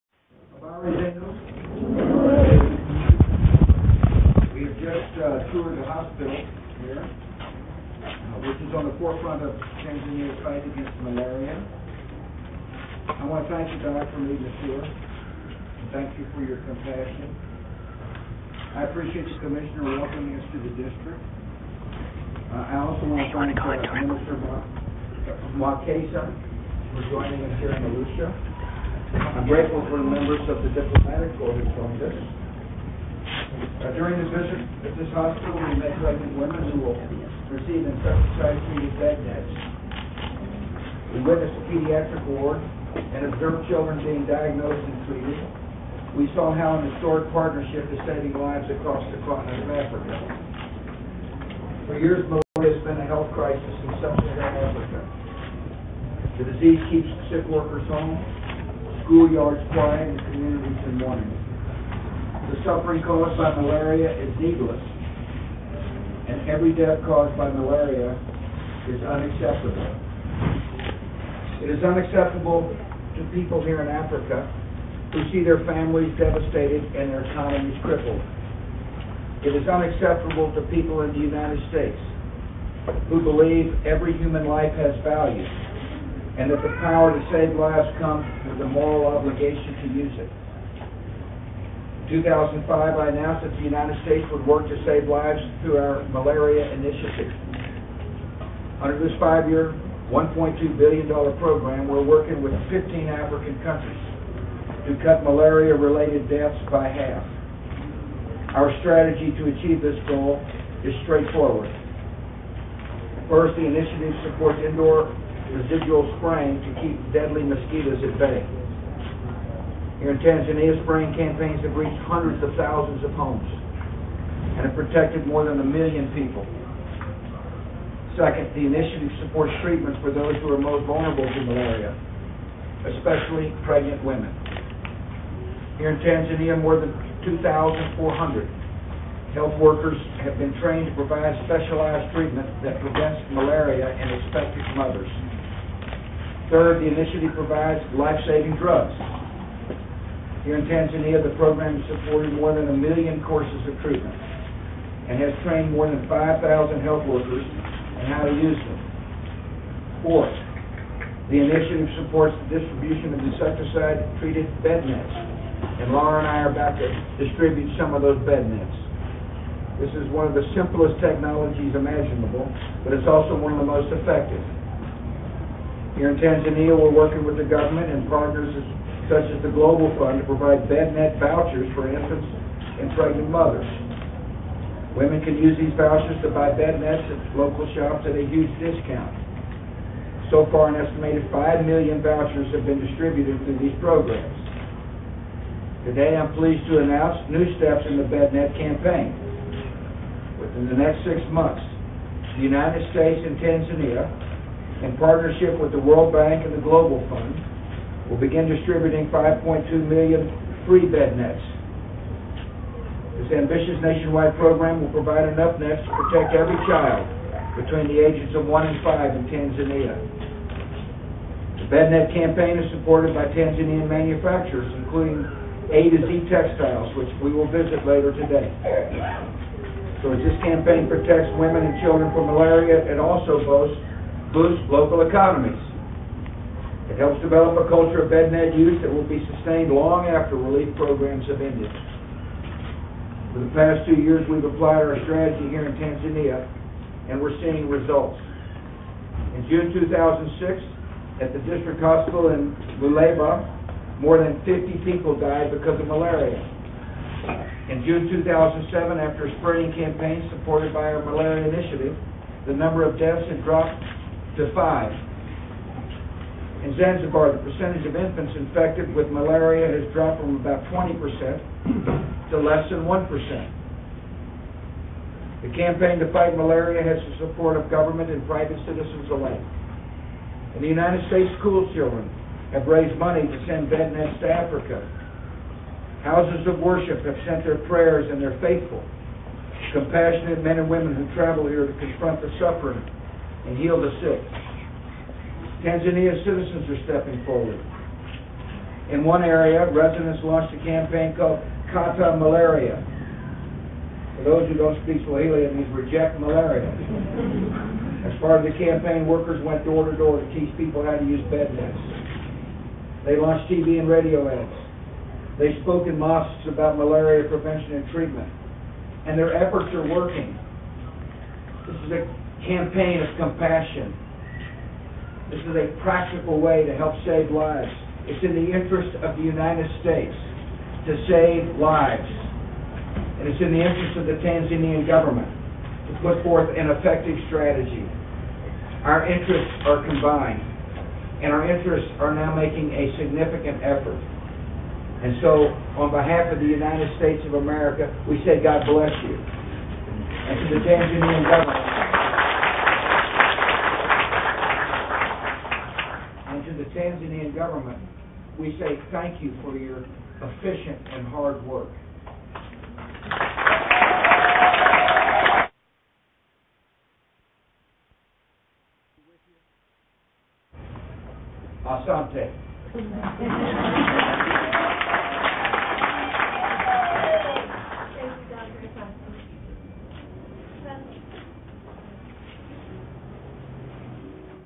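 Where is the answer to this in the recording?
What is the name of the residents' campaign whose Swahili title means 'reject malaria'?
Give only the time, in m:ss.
5:01.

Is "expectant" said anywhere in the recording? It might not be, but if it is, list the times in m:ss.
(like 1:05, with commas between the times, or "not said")
2:24.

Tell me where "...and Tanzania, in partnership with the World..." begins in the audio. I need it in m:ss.
3:23.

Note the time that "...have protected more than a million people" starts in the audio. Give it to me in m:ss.
2:04.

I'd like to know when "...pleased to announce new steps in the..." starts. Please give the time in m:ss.
3:16.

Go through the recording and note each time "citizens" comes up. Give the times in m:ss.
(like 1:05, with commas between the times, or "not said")
4:38, 4:56.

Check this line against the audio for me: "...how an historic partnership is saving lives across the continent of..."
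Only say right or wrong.
right.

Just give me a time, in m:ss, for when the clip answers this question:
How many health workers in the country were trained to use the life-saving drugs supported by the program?
2:36.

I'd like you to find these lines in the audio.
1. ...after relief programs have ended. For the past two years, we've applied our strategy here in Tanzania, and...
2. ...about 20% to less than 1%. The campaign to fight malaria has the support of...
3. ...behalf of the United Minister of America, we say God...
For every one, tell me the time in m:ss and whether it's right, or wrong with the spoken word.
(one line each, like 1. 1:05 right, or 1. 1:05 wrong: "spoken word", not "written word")
1. 4:00 right
2. 4:30 right
3. 5:45 wrong: "States", not "Minister".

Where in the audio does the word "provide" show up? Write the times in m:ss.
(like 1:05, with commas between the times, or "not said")
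2:20, 2:27, 3:00, 3:34.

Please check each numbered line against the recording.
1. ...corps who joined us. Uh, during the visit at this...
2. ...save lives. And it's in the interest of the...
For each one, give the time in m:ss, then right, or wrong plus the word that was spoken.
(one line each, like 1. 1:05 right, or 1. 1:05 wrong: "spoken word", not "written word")
1. 0:31 right
2. 5:31 right.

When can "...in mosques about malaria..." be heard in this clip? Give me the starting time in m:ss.
5:15.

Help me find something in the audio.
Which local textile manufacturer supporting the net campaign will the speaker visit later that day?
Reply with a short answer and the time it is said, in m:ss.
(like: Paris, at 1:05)
A to Z Textiles, at 3:45.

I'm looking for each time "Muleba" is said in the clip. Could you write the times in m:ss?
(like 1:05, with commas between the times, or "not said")
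4:12.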